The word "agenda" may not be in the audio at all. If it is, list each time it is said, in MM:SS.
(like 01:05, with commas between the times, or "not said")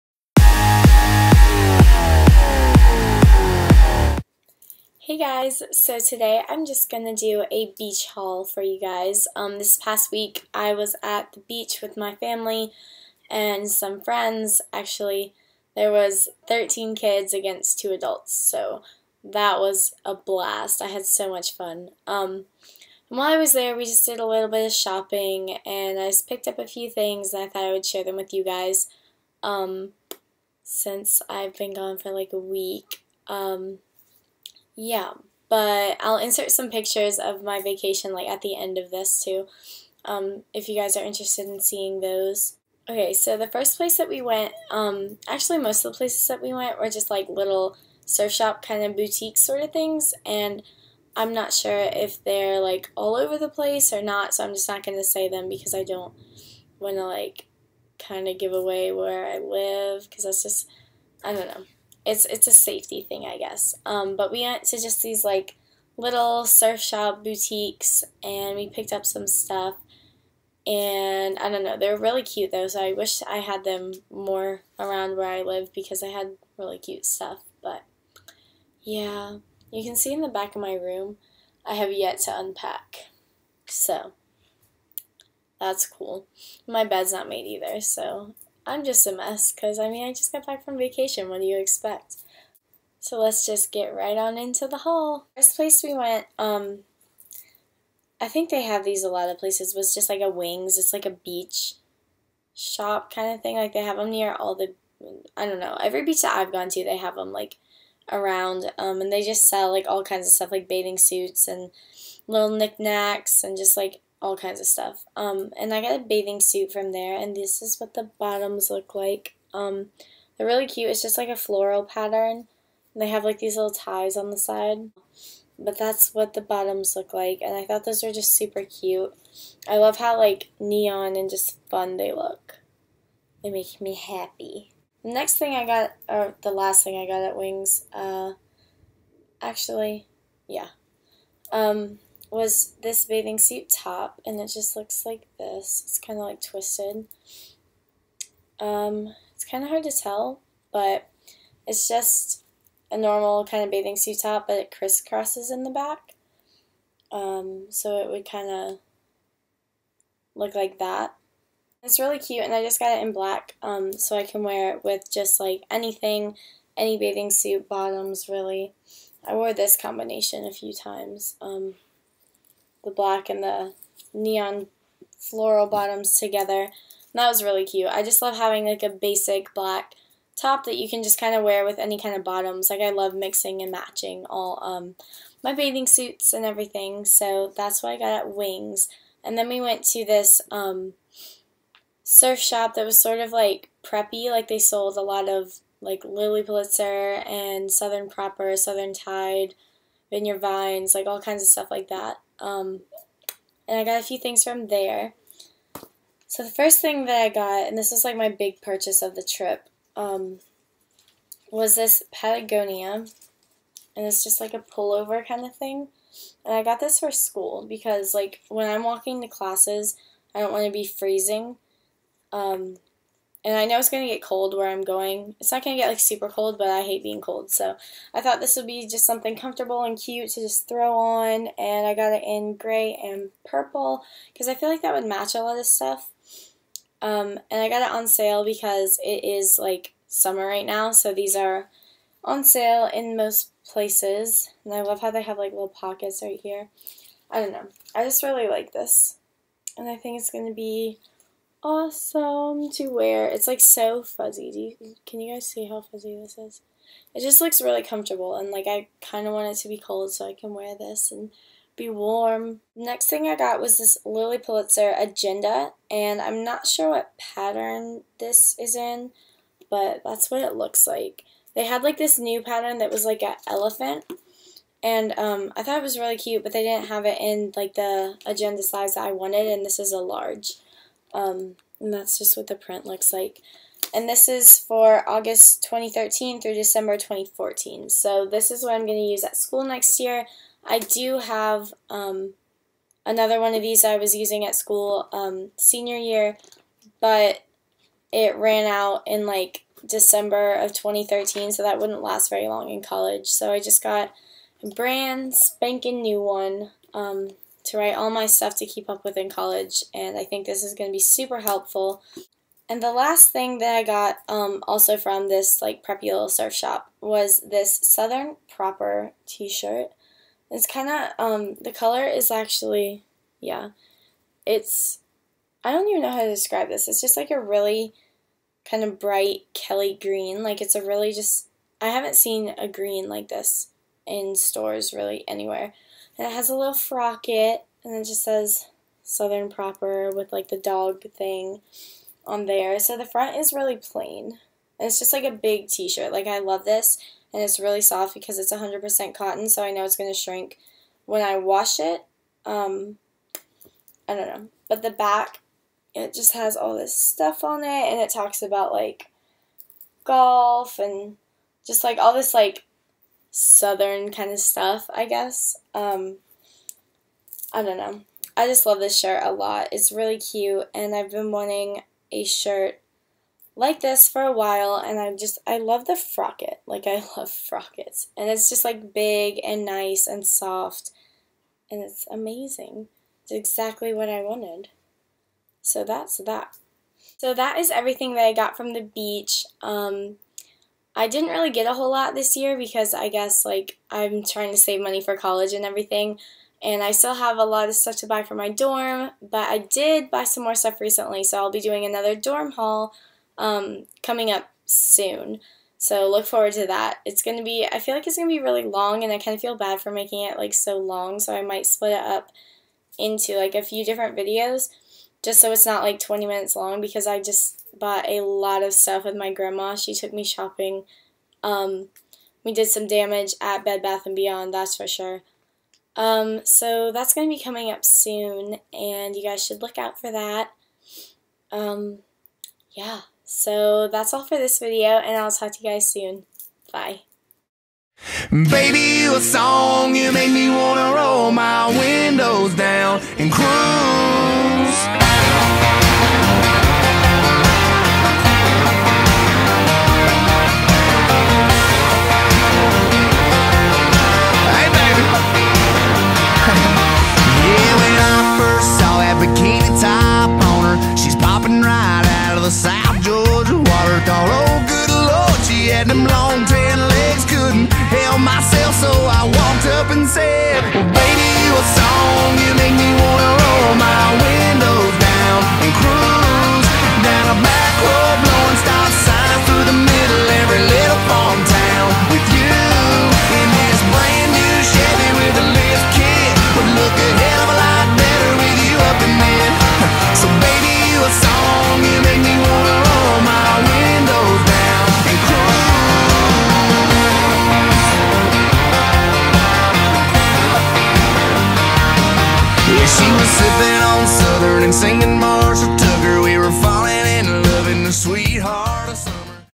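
04:24, 04:38.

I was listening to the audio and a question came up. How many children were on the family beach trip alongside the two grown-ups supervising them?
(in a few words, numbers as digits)
13.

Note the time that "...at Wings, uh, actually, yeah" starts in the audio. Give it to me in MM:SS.
02:17.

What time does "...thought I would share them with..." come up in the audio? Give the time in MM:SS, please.
00:27.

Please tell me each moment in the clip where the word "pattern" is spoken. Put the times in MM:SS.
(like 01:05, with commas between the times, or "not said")
02:01, 04:27, 04:32.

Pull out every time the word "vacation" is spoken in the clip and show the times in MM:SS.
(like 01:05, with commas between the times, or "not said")
00:37, 01:30.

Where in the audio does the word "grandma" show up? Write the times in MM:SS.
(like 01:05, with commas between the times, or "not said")
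06:59.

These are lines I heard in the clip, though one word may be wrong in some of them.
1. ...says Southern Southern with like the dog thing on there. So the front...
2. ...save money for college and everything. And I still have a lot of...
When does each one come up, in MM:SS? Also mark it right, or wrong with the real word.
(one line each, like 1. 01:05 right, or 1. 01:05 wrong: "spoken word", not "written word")
1. 05:38 wrong: "Proper", not "Southern"
2. 06:34 right.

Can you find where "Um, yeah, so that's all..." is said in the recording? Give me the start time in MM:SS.
07:11.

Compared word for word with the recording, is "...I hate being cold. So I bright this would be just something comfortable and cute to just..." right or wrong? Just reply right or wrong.
wrong.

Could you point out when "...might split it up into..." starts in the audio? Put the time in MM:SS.
06:51.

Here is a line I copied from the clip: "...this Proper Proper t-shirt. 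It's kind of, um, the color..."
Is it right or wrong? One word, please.
wrong.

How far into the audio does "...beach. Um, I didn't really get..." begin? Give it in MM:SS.
06:28.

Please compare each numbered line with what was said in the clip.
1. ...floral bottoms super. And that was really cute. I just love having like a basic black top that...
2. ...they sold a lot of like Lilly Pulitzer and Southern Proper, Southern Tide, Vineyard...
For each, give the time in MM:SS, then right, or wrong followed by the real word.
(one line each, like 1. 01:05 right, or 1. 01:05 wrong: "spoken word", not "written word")
1. 02:55 wrong: "together", not "super"
2. 03:14 right.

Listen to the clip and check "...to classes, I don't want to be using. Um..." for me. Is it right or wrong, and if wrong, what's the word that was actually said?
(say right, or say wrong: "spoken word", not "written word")
wrong: "freezing", not "using".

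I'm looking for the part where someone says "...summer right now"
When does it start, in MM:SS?
04:00.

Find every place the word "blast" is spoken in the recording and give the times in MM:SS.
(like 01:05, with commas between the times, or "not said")
00:20.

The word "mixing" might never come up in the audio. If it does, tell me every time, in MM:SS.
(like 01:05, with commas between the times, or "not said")
03:03.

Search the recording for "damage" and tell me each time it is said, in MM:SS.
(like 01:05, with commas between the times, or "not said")
07:02.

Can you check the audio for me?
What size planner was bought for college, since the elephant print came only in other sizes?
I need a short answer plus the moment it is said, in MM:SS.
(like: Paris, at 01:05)
Large, at 04:39.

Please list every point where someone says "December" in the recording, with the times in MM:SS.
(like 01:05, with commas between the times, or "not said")
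04:46, 04:59.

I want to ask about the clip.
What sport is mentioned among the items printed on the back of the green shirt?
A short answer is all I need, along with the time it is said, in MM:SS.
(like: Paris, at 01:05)
Golf, at 06:00.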